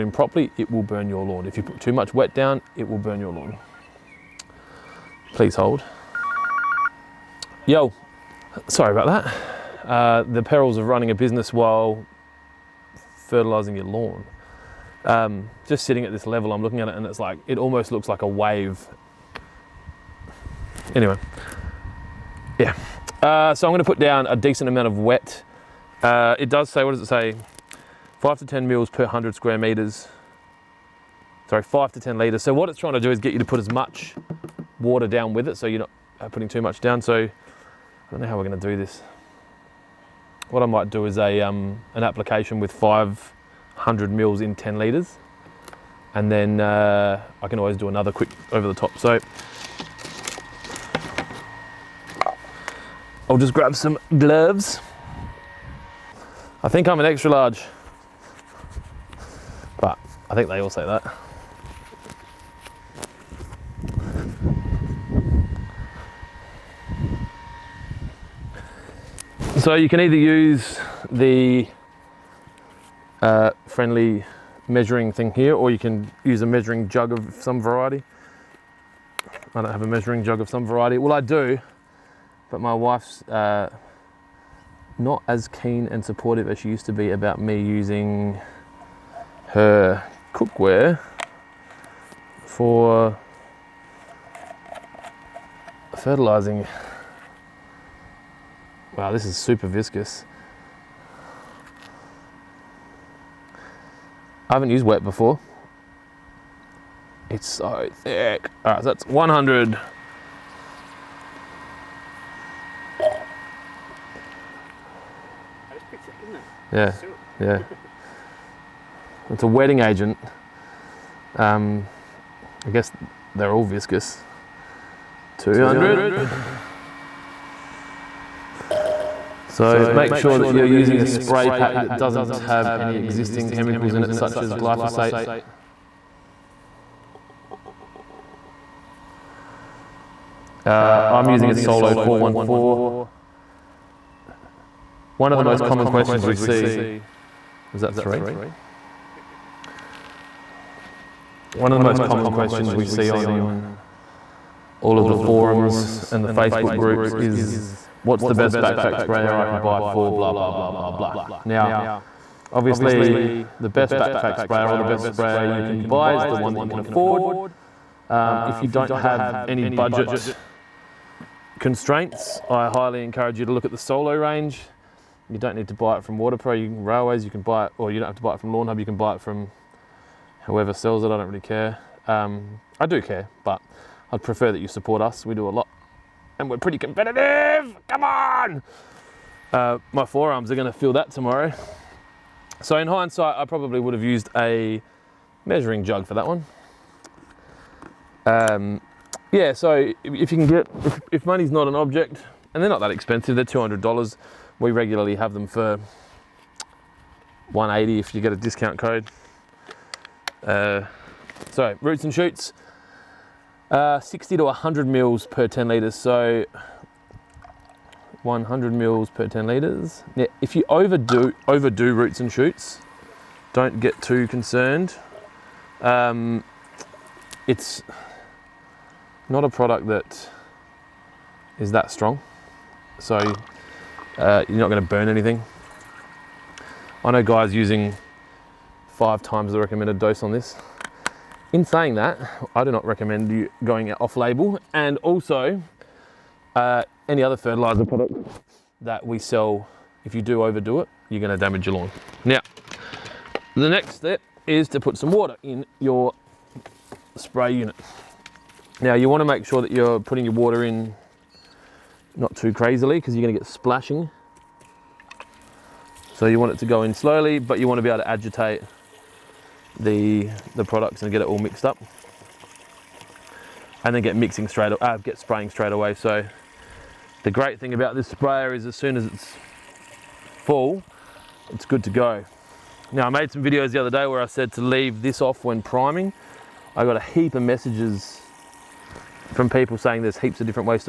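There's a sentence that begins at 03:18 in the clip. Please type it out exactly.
Um, yeah, so if you can get, if, money's not an object, and they're not that expensive, they're $200.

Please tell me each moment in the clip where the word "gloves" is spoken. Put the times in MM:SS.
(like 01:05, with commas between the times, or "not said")
00:54.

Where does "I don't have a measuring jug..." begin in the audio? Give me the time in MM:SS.
01:19.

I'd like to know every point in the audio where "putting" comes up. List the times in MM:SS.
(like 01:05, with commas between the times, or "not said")
00:36, 04:20.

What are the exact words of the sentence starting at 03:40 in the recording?
Now, if you overdo, overdo roots and shoots, don't get too concerned.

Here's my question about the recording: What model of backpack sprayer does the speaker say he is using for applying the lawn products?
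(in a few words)
Solo 414.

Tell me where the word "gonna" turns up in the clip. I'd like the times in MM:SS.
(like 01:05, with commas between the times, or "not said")
00:23, 00:38, 03:54, 04:11, 04:23.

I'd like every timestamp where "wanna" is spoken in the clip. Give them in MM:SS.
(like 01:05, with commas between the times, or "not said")
04:19, 04:27.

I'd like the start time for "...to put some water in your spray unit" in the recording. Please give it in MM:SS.
04:14.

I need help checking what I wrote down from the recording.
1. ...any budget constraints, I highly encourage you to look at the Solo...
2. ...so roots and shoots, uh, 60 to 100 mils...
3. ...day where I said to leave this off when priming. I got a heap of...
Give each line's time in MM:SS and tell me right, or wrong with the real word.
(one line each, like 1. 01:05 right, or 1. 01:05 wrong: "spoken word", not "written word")
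1. 02:49 right
2. 03:31 right
3. 04:43 right.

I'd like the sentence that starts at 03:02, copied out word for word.
Um, I do care, but I'd prefer that you support us.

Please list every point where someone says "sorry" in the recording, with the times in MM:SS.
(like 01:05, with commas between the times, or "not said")
00:08, 00:31.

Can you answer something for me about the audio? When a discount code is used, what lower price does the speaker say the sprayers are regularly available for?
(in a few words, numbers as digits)
180.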